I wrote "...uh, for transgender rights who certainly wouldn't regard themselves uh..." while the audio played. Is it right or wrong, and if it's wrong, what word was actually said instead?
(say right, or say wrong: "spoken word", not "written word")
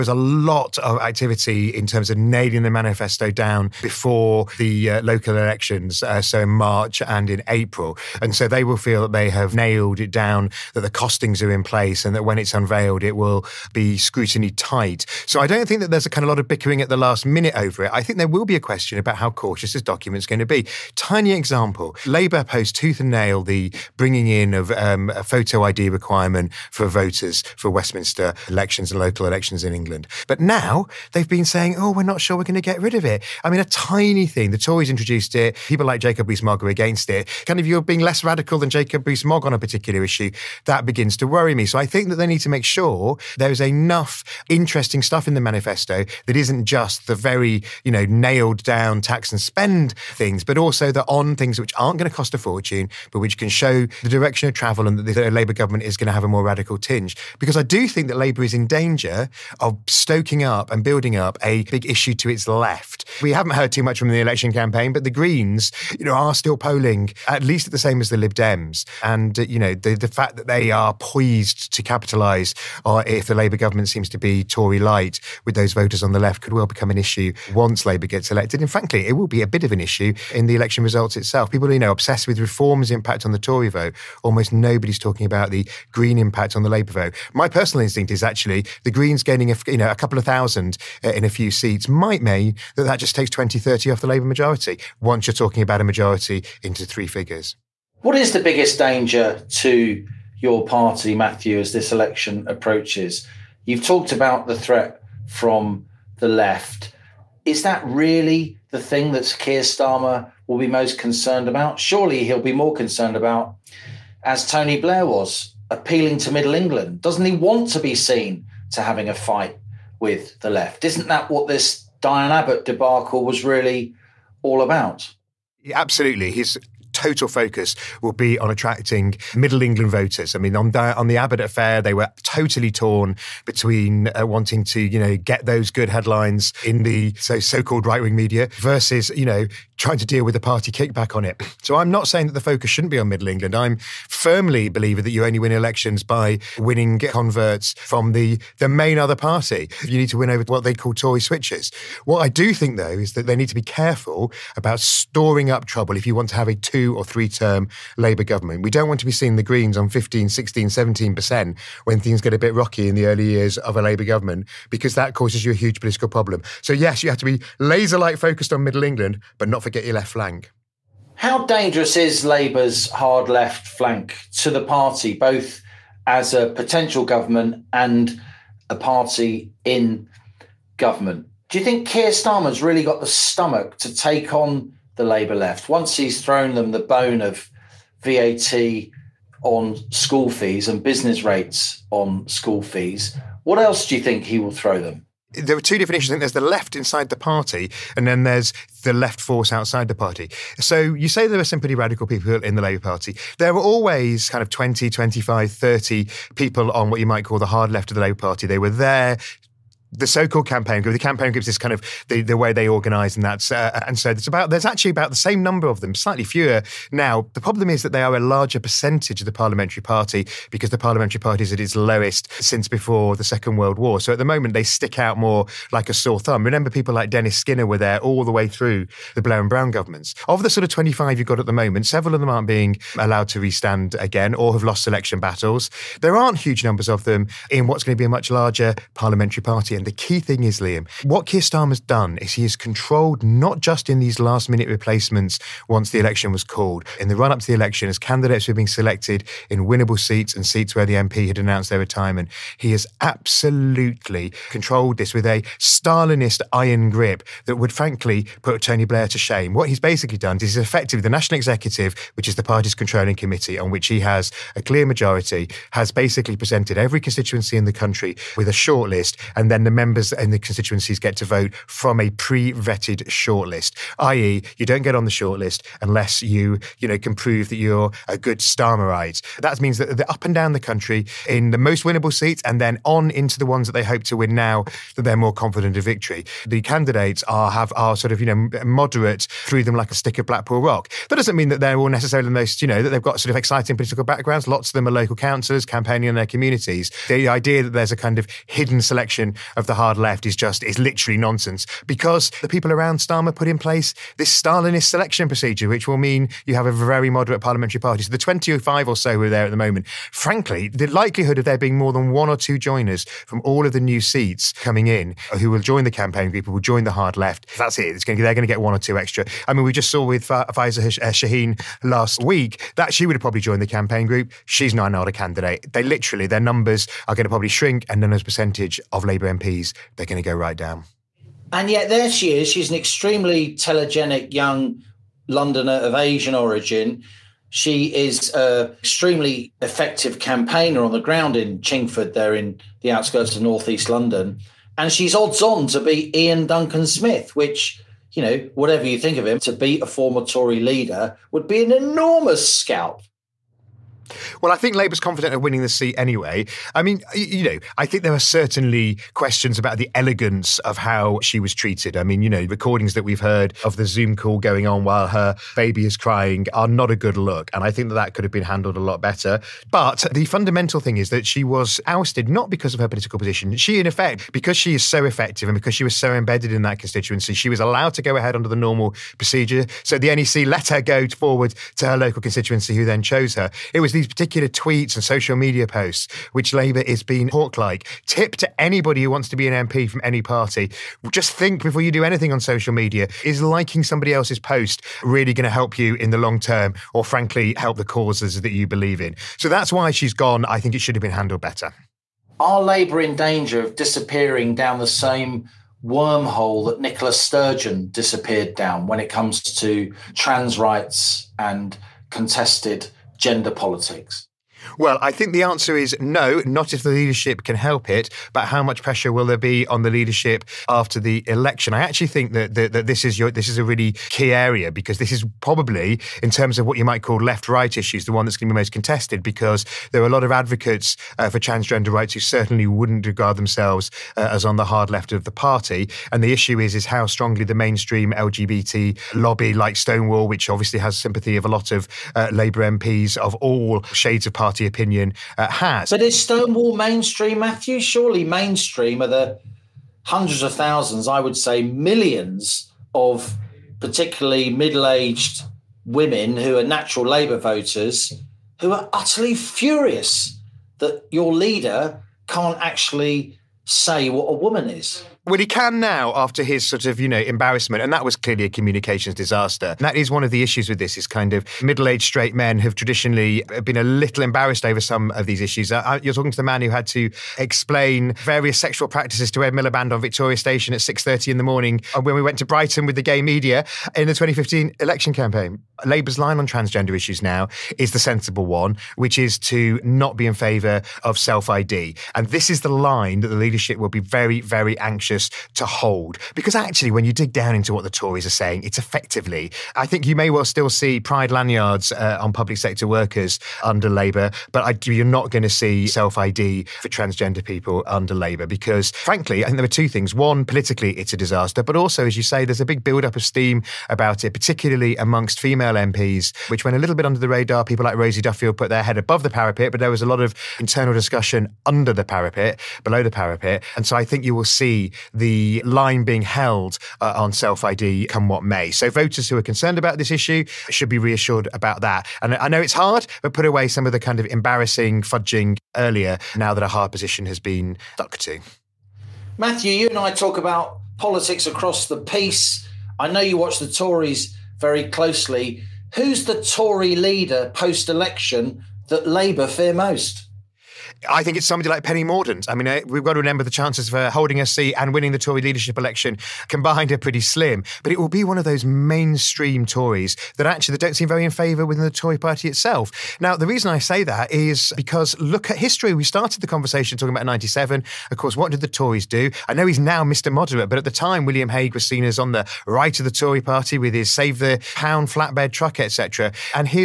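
right.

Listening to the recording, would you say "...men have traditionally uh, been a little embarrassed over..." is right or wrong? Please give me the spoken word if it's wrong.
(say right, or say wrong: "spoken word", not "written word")
right.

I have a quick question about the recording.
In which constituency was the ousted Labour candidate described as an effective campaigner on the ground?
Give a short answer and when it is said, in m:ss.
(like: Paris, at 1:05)
Chingford, at 5:41.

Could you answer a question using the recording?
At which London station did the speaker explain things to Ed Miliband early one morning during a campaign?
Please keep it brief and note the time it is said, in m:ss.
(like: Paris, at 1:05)
Victoria Station, at 7:59.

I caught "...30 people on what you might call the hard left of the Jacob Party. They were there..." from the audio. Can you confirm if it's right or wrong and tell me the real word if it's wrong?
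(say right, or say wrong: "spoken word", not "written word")
wrong: "Labour", not "Jacob".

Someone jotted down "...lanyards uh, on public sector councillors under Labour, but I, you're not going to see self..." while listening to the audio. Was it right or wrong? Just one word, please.
wrong.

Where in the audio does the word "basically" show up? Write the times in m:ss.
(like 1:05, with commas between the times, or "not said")
4:19, 4:25.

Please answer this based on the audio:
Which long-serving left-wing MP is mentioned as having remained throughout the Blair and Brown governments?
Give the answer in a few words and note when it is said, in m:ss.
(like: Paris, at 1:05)
Dennis Skinner, at 3:47.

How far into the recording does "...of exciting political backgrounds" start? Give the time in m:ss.
4:53.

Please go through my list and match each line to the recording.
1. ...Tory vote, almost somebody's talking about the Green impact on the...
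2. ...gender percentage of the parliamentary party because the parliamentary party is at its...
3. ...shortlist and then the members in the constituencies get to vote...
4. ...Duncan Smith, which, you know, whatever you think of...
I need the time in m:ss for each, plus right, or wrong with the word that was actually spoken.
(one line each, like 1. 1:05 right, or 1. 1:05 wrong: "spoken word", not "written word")
1. 1:23 wrong: "nobody", not "somebody"
2. 3:38 wrong: "larger", not "gender"
3. 4:28 right
4. 5:46 right.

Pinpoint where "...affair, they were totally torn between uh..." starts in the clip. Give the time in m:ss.
2:11.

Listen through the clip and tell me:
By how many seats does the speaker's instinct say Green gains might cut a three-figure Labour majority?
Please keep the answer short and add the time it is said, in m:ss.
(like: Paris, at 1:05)
20, 30, at 1:33.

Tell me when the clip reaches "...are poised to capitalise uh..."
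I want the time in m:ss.
1:10.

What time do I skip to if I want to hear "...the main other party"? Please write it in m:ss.
2:28.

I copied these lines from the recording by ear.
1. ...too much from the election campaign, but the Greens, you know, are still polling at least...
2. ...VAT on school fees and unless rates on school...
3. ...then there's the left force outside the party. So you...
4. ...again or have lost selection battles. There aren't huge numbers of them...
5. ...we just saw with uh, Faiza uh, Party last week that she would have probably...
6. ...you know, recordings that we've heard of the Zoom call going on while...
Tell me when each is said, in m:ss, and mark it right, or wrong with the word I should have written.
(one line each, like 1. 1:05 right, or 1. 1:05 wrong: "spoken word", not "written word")
1. 1:03 right
2. 3:08 wrong: "business", not "unless"
3. 3:18 right
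4. 3:53 right
5. 5:19 wrong: "Shaheen", not "Party"
6. 6:02 right.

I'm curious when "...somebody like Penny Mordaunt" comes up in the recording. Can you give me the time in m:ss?
9:11.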